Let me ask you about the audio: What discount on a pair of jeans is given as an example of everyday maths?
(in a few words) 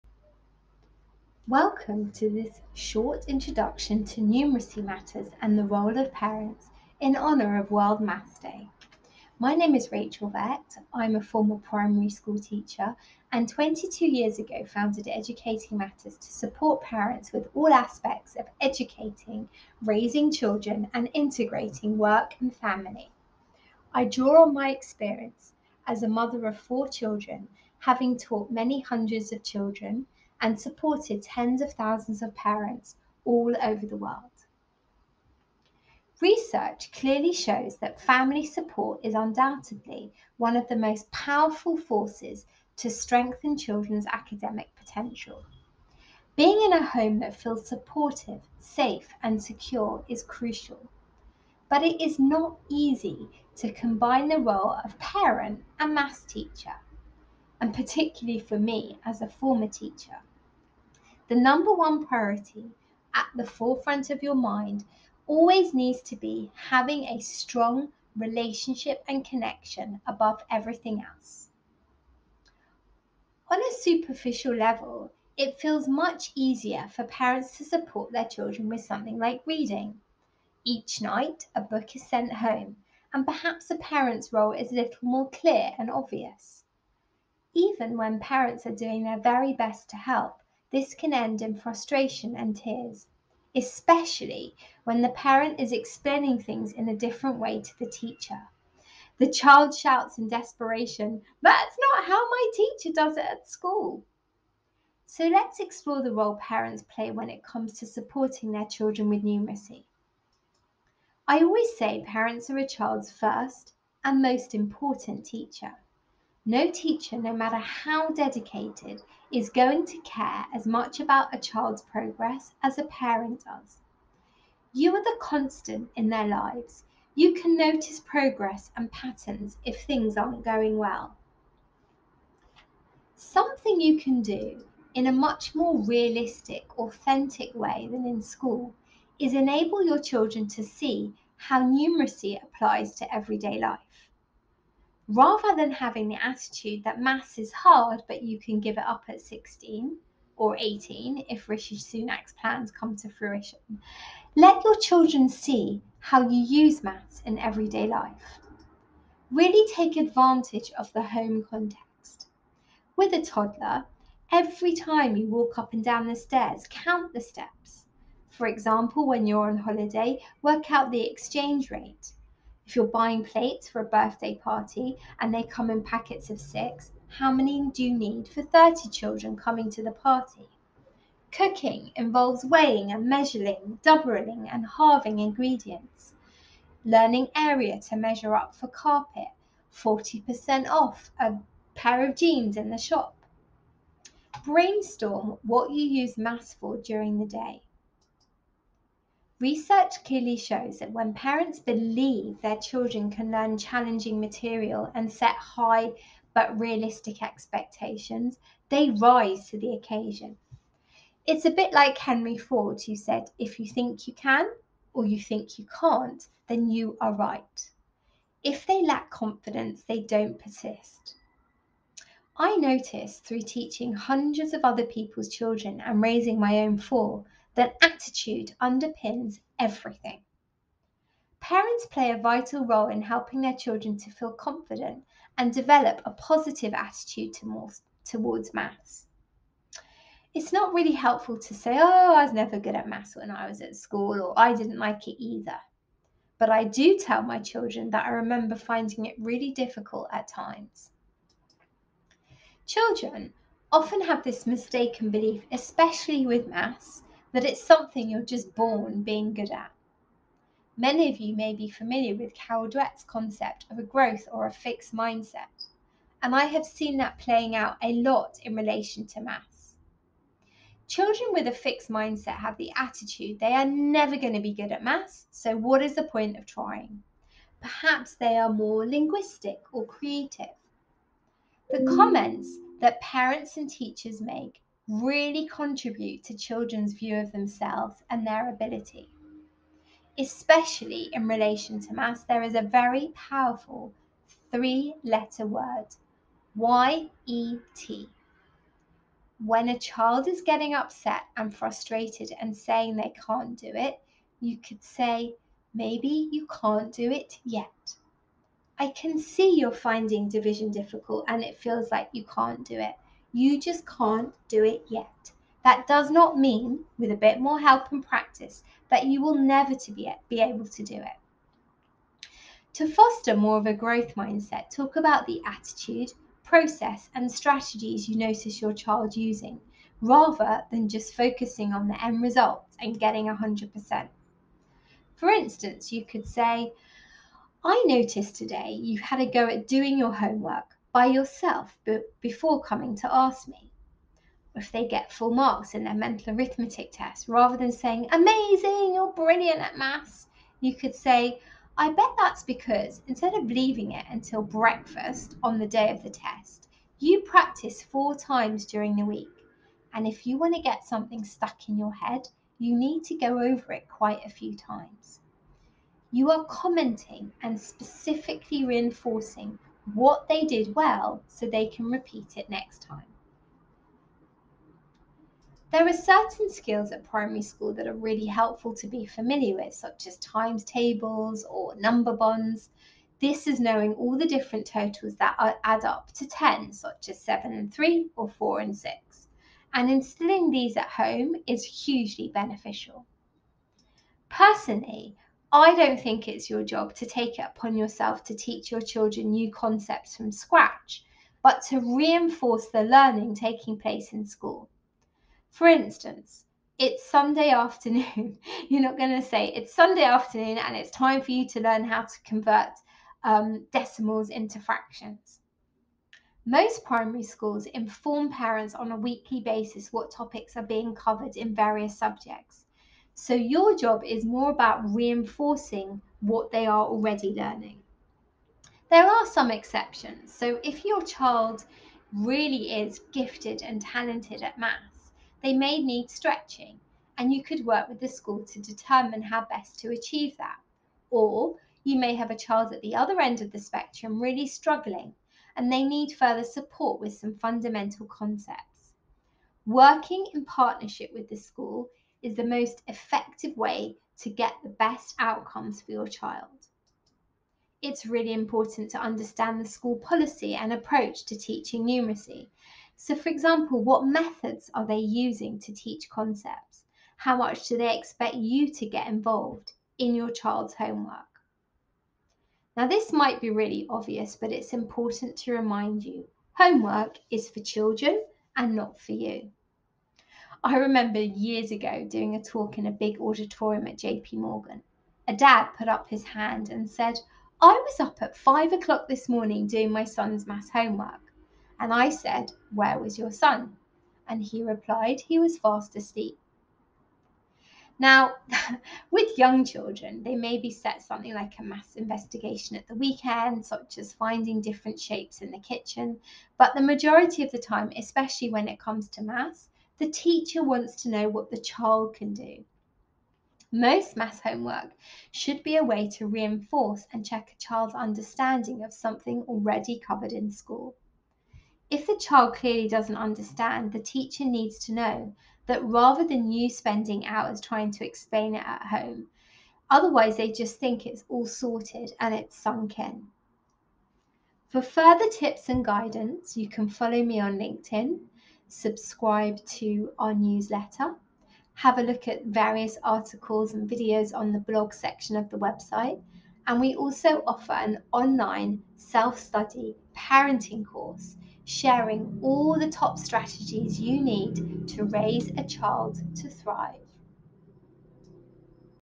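40%.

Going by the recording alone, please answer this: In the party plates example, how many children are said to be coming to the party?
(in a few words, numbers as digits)
30.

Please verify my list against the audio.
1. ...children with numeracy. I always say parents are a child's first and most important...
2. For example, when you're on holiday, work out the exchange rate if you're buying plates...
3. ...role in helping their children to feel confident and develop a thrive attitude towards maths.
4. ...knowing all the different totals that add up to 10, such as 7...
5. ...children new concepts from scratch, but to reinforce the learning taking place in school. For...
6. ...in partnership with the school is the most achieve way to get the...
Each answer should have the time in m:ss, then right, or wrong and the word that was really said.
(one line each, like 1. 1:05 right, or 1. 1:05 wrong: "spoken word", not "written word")
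1. 1:48 right
2. 2:48 right
3. 3:52 wrong: "positive", not "thrive"
4. 6:23 right
5. 6:38 right
6. 7:30 wrong: "effective", not "achieve".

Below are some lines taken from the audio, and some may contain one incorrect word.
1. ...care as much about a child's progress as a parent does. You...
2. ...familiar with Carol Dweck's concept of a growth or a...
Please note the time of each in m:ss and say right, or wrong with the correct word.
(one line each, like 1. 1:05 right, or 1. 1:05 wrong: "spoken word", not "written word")
1. 1:59 right
2. 4:21 right.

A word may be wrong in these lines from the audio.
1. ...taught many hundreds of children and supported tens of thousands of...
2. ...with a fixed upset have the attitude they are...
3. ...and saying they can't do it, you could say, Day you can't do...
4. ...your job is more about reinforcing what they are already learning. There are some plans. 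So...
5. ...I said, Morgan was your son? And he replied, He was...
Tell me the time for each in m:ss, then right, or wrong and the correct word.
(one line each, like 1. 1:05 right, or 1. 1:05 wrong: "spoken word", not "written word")
1. 0:28 right
2. 4:31 wrong: "mindset", not "upset"
3. 5:02 wrong: "Maybe", not "Day"
4. 7:03 wrong: "exceptions", not "plans"
5. 8:11 wrong: "Where", not "Morgan".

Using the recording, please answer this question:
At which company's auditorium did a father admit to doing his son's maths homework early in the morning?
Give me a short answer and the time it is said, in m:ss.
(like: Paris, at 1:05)
JP Morgan, at 8:03.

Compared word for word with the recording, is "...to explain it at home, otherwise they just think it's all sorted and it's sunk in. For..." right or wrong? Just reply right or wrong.
right.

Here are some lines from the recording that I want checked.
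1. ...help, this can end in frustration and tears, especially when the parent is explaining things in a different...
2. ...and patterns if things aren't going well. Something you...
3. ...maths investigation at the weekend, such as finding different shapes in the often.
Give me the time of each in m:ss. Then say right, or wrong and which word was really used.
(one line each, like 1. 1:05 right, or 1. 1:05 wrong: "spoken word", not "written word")
1. 1:29 right
2. 2:08 right
3. 8:21 wrong: "kitchen", not "often".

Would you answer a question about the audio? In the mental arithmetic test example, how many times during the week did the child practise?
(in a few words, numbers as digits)
4.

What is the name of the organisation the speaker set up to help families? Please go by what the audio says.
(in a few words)
Educating Matters.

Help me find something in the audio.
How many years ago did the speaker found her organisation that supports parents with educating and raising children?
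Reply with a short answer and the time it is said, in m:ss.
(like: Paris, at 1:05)
22, at 0:13.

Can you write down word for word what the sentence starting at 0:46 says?
Being in a home that feels supportive, safe, and secure is crucial.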